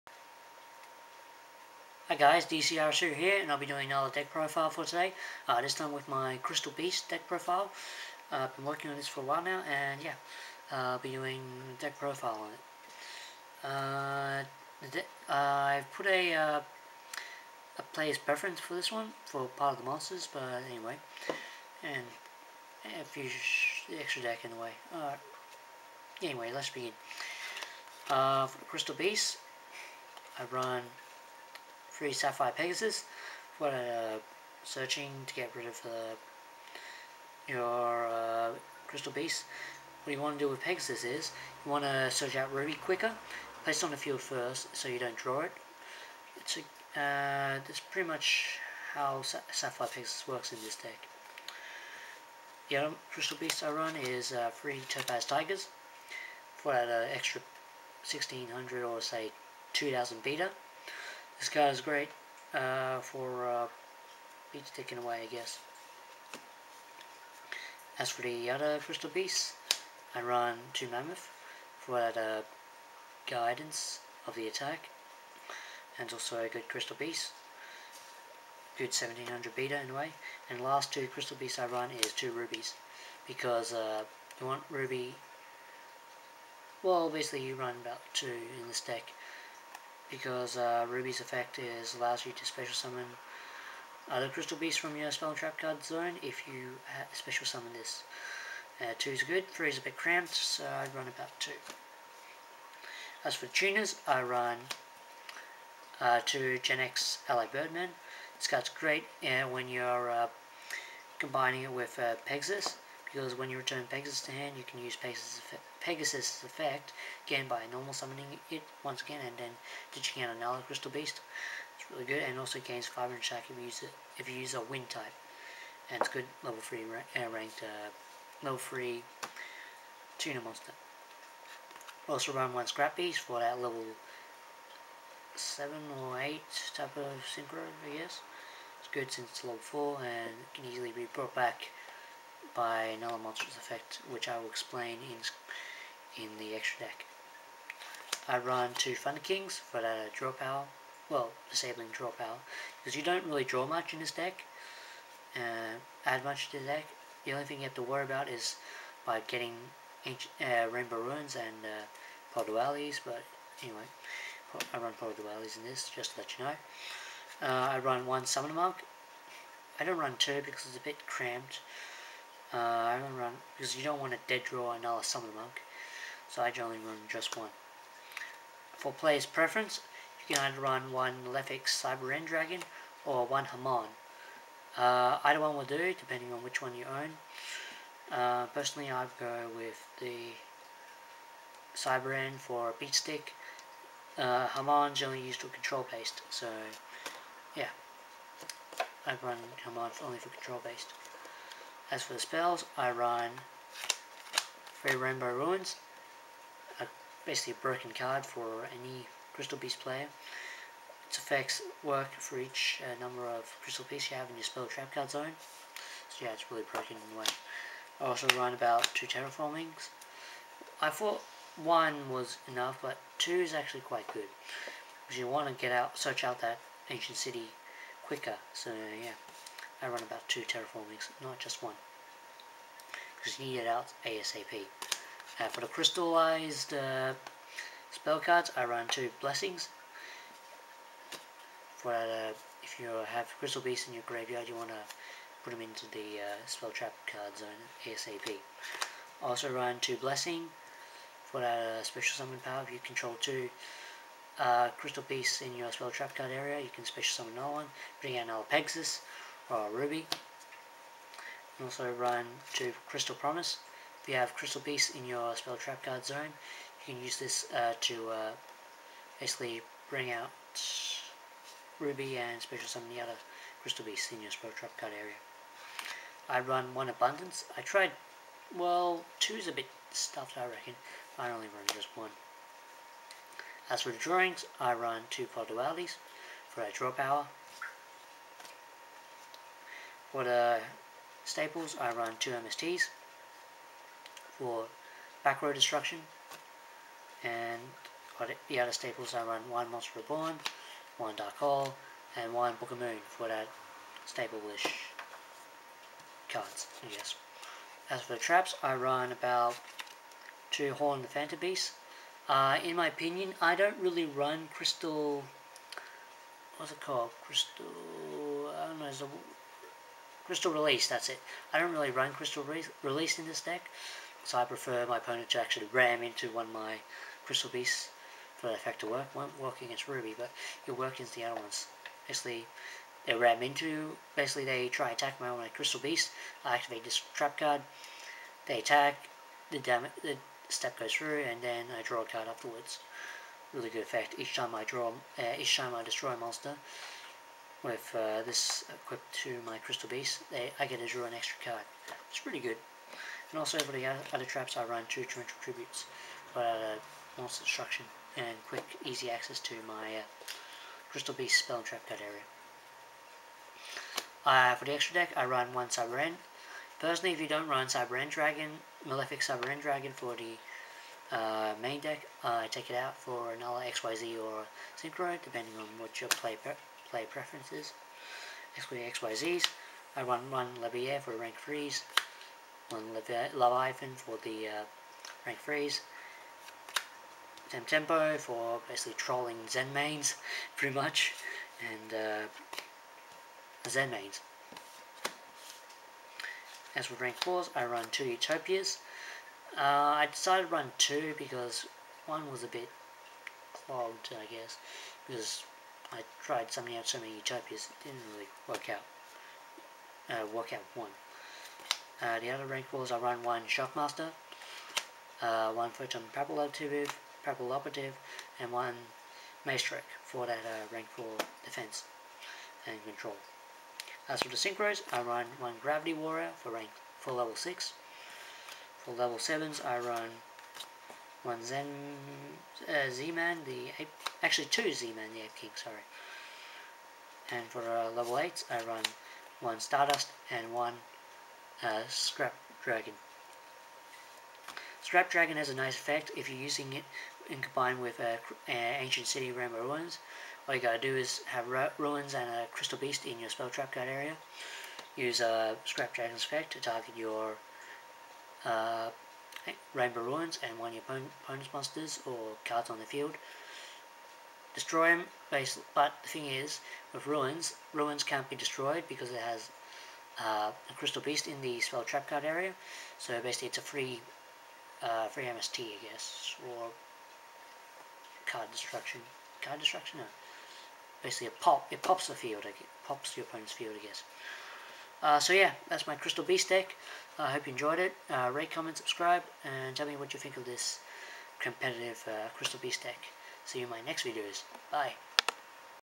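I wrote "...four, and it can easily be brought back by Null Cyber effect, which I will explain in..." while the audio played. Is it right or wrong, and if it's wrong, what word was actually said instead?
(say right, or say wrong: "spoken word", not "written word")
wrong: "Monsters", not "Cyber".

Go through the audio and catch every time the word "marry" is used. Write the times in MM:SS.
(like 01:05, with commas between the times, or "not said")
not said.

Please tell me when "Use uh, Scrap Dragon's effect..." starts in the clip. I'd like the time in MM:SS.
07:34.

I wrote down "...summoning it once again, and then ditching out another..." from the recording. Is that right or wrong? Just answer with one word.
right.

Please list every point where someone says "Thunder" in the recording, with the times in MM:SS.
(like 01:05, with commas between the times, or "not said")
02:28.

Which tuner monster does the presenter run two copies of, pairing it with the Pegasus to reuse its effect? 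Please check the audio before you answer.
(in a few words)
Genex Ally Birdman.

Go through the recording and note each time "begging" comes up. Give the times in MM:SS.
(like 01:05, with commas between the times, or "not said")
not said.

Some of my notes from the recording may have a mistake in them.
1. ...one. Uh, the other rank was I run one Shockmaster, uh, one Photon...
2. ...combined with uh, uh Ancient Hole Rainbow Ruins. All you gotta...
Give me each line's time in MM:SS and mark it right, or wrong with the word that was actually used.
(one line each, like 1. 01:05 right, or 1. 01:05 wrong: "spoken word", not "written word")
1. 06:50 right
2. 07:27 wrong: "City", not "Hole".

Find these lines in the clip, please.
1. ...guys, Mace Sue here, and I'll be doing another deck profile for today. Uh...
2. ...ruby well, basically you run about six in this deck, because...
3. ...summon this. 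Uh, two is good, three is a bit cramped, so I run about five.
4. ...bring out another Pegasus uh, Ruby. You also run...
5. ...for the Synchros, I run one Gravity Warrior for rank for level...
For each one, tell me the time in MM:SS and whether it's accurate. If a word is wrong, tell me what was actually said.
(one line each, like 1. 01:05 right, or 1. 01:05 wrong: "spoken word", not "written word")
1. 00:02 wrong: "DCR", not "Mace"
2. 01:24 wrong: "two", not "six"
3. 01:37 wrong: "two", not "five"
4. 04:17 right
5. 07:04 right.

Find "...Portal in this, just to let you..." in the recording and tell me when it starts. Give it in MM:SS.
02:44.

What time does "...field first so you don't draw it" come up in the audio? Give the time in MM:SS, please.
00:43.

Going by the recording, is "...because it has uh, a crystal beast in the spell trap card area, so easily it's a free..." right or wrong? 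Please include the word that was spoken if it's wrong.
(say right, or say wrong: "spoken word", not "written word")
wrong: "basically", not "easily".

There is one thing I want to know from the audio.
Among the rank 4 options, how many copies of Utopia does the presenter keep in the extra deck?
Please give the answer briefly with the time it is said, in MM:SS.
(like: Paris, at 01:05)
2, at 06:37.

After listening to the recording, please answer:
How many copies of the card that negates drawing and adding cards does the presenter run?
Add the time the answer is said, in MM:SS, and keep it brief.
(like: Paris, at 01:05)
2, at 02:28.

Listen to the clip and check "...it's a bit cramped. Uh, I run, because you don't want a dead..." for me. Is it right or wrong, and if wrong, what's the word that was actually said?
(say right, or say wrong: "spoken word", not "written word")
right.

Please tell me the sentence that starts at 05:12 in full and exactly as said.
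Uh, in my opinion, I don't really run Crystal...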